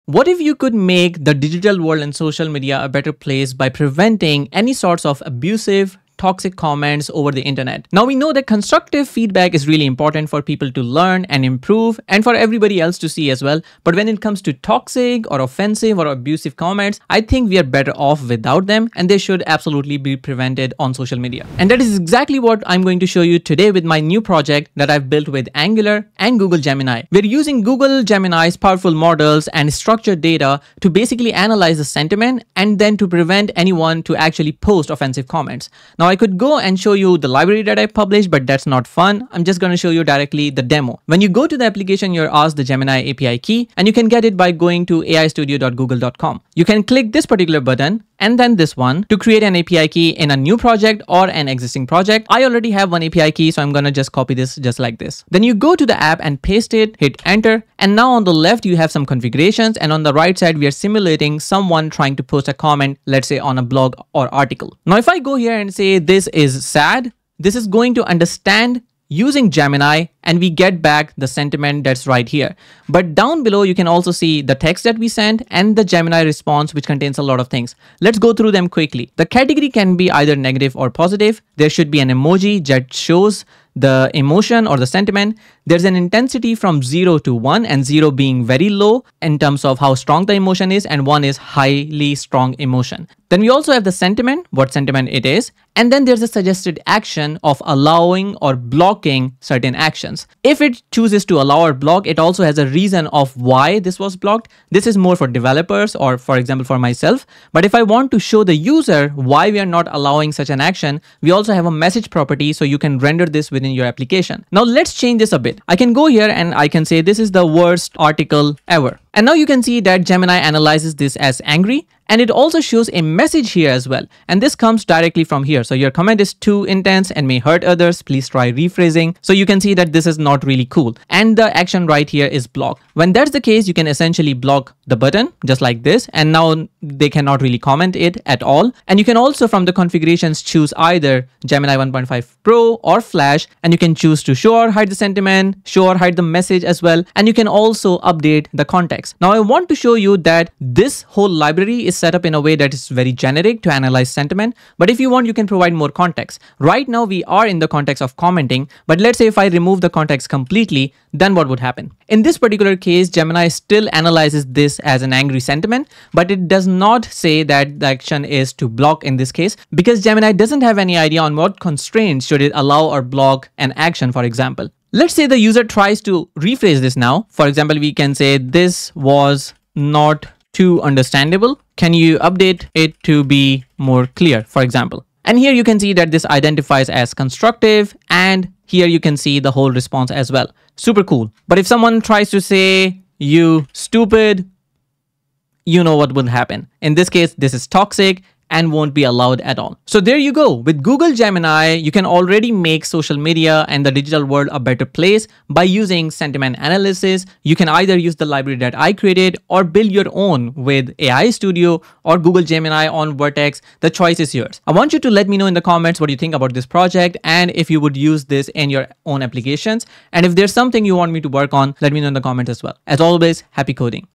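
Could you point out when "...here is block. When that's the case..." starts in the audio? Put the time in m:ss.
2:12.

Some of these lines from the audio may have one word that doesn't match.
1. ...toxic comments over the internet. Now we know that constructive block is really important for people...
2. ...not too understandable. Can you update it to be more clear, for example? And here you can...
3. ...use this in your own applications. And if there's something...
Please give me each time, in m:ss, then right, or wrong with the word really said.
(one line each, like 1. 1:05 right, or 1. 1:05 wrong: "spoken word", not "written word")
1. 0:06 wrong: "feedback", not "block"
2. 2:59 right
3. 3:37 right.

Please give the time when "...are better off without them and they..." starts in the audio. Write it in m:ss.
0:17.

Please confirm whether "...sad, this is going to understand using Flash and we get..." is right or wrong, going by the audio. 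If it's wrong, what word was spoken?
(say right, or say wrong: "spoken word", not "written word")
wrong: "Gemini", not "Flash".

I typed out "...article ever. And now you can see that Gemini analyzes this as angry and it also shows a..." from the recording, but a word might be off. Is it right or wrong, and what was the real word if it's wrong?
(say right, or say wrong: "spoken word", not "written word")
right.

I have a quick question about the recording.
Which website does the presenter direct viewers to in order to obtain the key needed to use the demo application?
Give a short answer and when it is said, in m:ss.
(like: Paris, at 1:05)
aistudio.google.com, at 0:45.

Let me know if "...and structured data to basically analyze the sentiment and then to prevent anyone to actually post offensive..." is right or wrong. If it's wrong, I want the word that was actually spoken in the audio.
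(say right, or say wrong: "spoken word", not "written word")
right.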